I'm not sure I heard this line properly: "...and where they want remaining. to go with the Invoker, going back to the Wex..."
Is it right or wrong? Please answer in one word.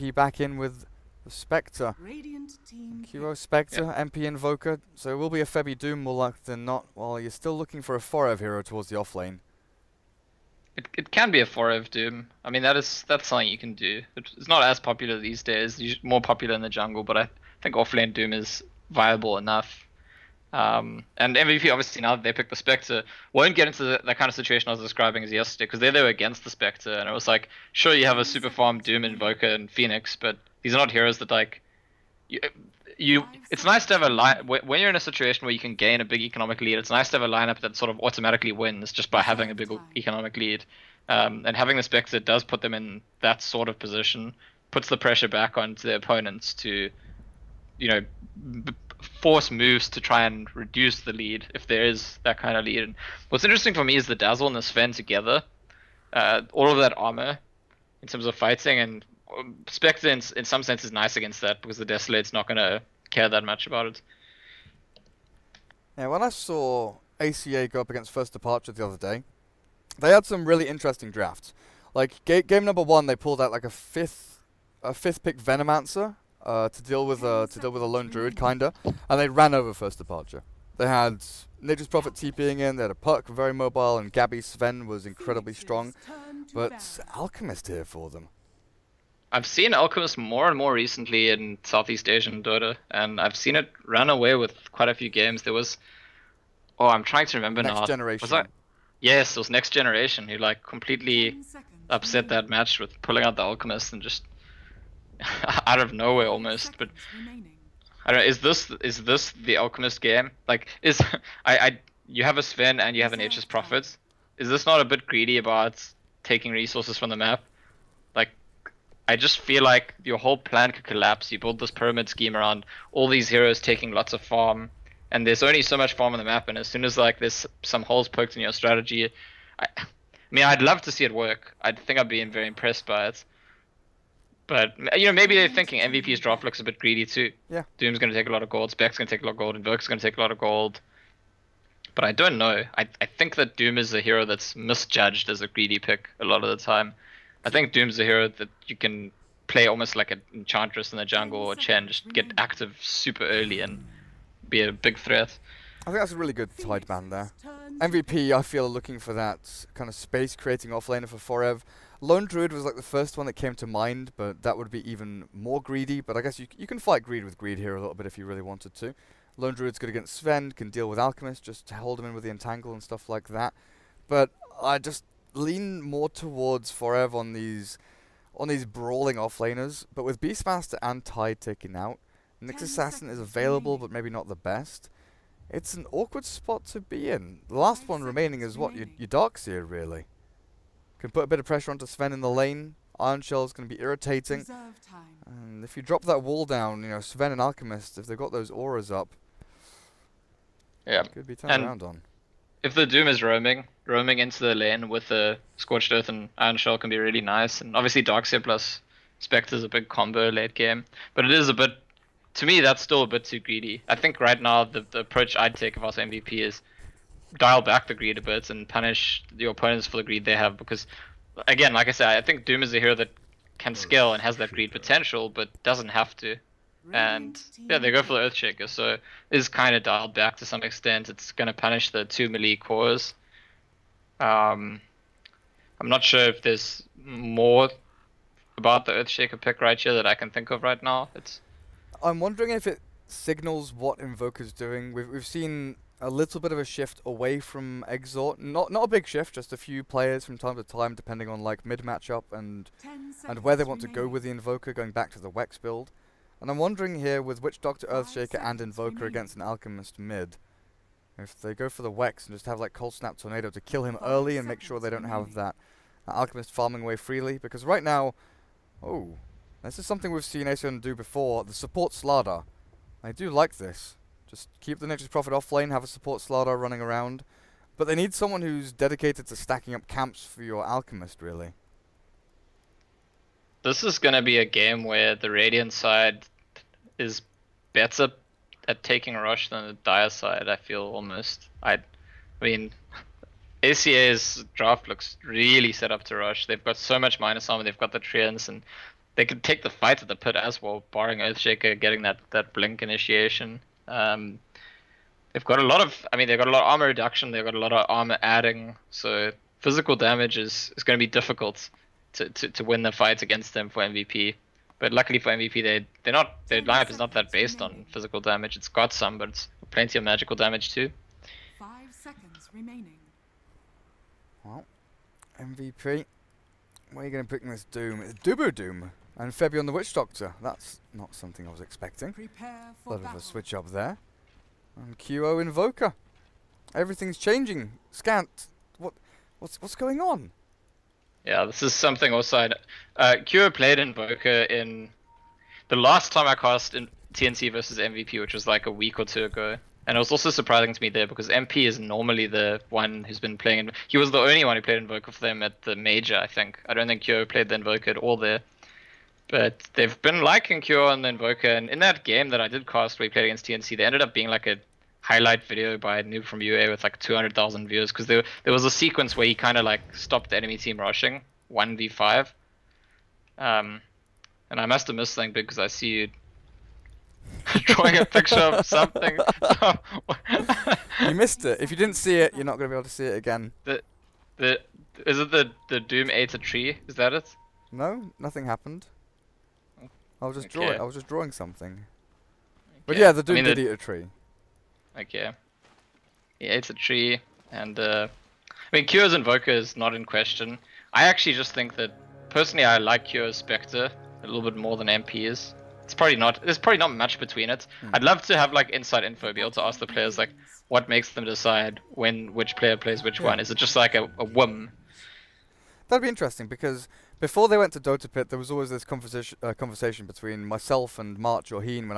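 right.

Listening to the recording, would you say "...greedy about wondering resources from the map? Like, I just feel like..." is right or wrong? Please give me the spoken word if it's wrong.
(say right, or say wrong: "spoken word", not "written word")
wrong: "taking", not "wondering".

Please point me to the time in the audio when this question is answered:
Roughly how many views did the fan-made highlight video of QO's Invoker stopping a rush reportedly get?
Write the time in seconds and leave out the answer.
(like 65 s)
366 s.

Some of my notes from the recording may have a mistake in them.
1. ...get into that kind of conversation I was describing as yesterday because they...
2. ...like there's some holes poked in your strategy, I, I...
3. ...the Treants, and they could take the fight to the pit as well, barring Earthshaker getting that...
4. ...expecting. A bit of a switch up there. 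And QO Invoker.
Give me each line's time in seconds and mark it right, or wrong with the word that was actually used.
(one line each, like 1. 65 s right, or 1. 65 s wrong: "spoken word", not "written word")
1. 23 s wrong: "situation", not "conversation"
2. 126 s right
3. 297 s right
4. 331 s right.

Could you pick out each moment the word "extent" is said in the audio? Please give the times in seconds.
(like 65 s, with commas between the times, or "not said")
230 s.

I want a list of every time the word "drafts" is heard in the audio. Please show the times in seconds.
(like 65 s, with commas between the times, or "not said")
71 s, 294 s.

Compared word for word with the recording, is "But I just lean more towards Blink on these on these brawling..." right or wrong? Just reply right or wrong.
wrong.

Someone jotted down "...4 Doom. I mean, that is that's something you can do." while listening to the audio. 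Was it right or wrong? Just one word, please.
right.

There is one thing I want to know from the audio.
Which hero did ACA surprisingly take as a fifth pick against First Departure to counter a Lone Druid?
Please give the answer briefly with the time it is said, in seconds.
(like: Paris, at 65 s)
Venomancer, at 75 s.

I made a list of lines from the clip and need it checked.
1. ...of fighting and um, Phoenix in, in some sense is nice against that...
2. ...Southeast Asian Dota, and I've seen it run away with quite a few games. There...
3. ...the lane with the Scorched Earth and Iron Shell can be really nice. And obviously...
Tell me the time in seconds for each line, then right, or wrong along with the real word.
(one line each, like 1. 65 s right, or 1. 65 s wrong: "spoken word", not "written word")
1. 58 s wrong: "Spectre", not "Phoenix"
2. 91 s right
3. 204 s right.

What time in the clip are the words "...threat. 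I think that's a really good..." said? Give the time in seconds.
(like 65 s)
154 s.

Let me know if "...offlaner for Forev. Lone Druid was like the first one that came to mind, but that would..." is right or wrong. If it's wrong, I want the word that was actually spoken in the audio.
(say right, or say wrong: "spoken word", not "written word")
right.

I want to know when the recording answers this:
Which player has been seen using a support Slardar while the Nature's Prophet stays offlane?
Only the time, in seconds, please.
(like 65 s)
270 s.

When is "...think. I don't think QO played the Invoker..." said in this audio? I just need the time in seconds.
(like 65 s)
356 s.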